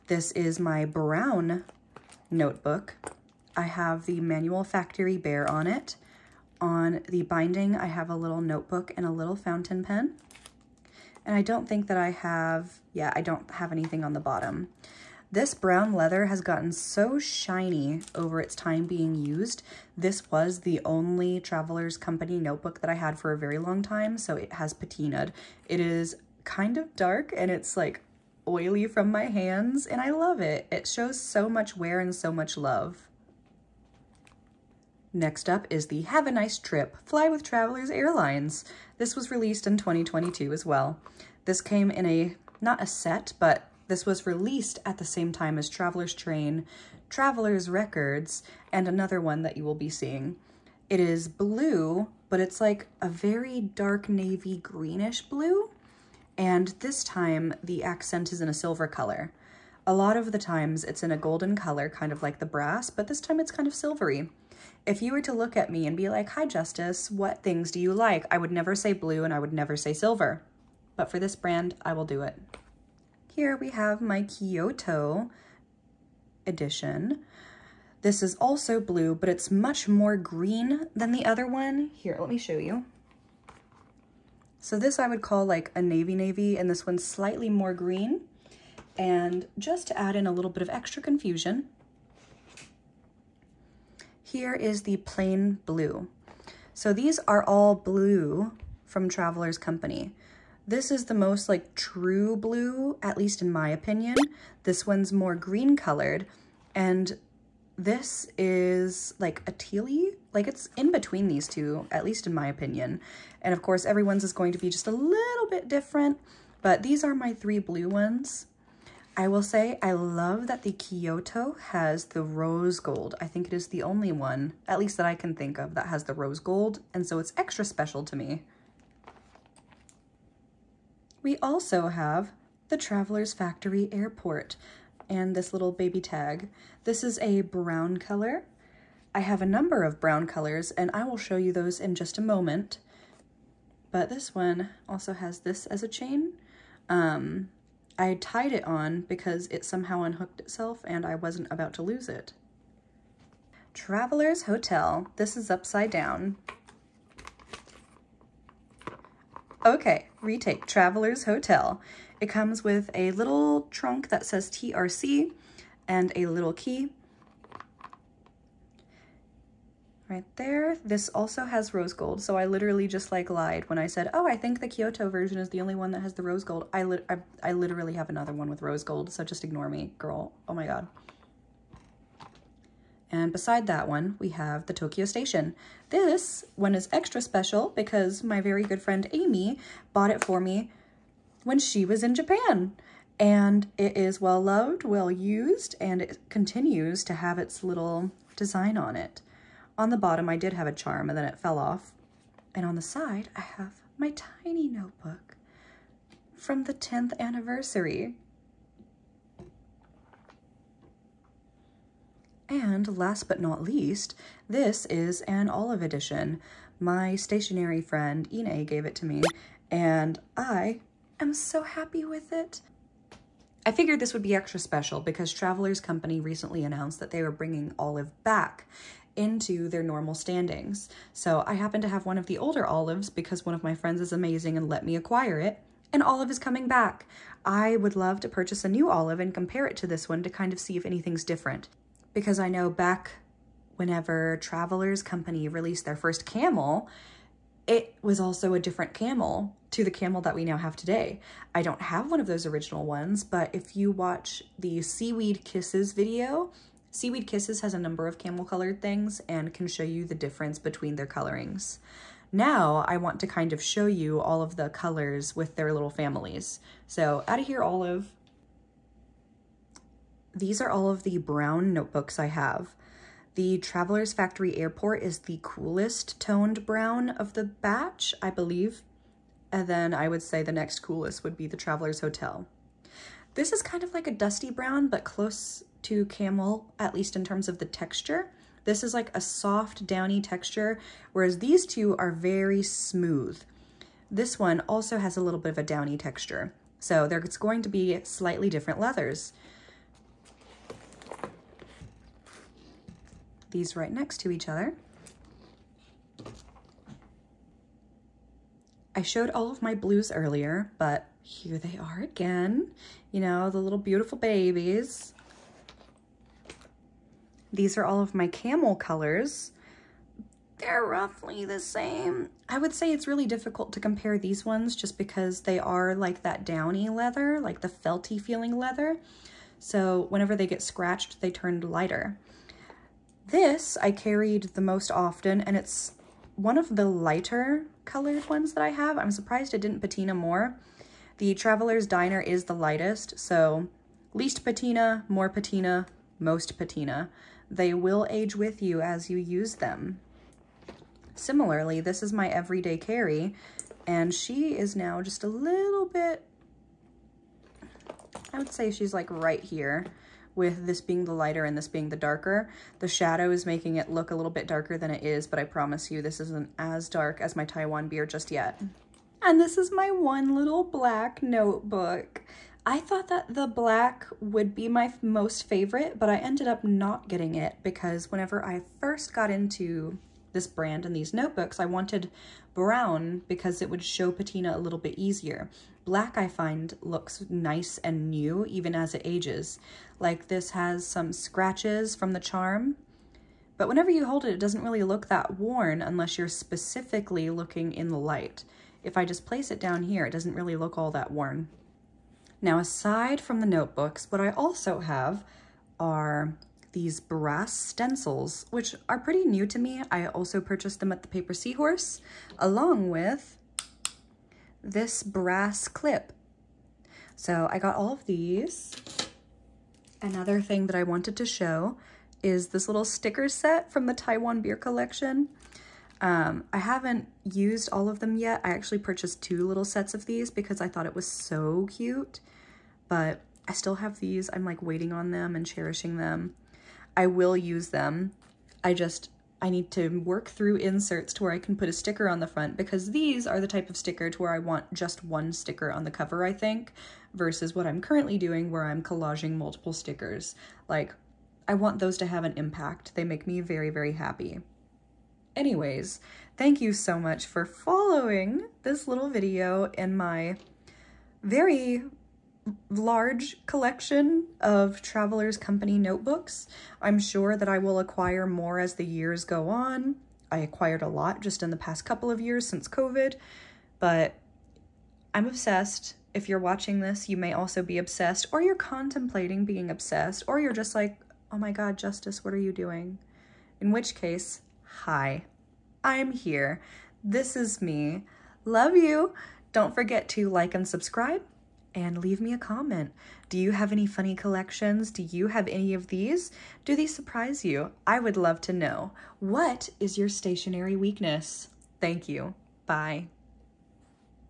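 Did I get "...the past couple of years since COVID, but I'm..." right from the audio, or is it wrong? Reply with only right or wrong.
right.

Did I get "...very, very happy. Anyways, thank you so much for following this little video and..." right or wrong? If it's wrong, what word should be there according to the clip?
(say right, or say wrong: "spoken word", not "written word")
right.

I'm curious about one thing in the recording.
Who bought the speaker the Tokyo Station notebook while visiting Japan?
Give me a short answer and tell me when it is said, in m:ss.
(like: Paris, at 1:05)
Amy, at 3:09.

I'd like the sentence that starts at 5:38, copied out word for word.
I'm surprised it didn't patina more.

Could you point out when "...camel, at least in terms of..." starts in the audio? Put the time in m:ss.
4:46.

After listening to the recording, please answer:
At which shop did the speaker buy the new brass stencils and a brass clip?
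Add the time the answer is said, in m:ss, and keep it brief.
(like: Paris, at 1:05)
The Paper Seahorse, at 6:51.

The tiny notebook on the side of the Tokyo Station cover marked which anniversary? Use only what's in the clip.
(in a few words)
10th anniversary.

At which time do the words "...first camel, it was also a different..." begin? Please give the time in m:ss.
4:05.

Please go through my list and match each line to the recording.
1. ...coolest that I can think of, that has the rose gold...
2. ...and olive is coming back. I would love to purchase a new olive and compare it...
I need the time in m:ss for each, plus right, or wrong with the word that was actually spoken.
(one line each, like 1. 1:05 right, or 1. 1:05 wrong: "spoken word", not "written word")
1. 2:04 wrong: "least", not "coolest"
2. 3:55 right.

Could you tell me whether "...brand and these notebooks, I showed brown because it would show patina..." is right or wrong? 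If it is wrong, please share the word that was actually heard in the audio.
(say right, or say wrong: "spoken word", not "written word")
wrong: "wanted", not "showed".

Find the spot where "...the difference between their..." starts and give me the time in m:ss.
4:20.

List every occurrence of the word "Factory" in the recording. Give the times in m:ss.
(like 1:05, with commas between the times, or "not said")
0:04, 2:13, 4:34.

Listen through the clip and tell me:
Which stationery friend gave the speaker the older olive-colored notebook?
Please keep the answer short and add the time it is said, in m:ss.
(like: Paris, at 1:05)
Ine, at 3:38.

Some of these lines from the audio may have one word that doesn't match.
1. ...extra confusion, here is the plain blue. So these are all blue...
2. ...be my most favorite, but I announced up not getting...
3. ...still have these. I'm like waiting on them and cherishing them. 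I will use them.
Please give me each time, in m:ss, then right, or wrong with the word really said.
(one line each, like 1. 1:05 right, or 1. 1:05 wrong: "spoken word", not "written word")
1. 1:30 right
2. 6:14 wrong: "ended", not "announced"
3. 7:13 right.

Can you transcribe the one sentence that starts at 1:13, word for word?
Here we have my Kyoto edition.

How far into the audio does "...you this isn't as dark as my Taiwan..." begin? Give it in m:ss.
6:05.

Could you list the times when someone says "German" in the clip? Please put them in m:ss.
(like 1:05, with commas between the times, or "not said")
not said.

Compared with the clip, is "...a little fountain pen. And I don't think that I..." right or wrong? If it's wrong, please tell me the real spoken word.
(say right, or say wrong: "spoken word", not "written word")
right.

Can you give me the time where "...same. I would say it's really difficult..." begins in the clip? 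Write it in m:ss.
5:21.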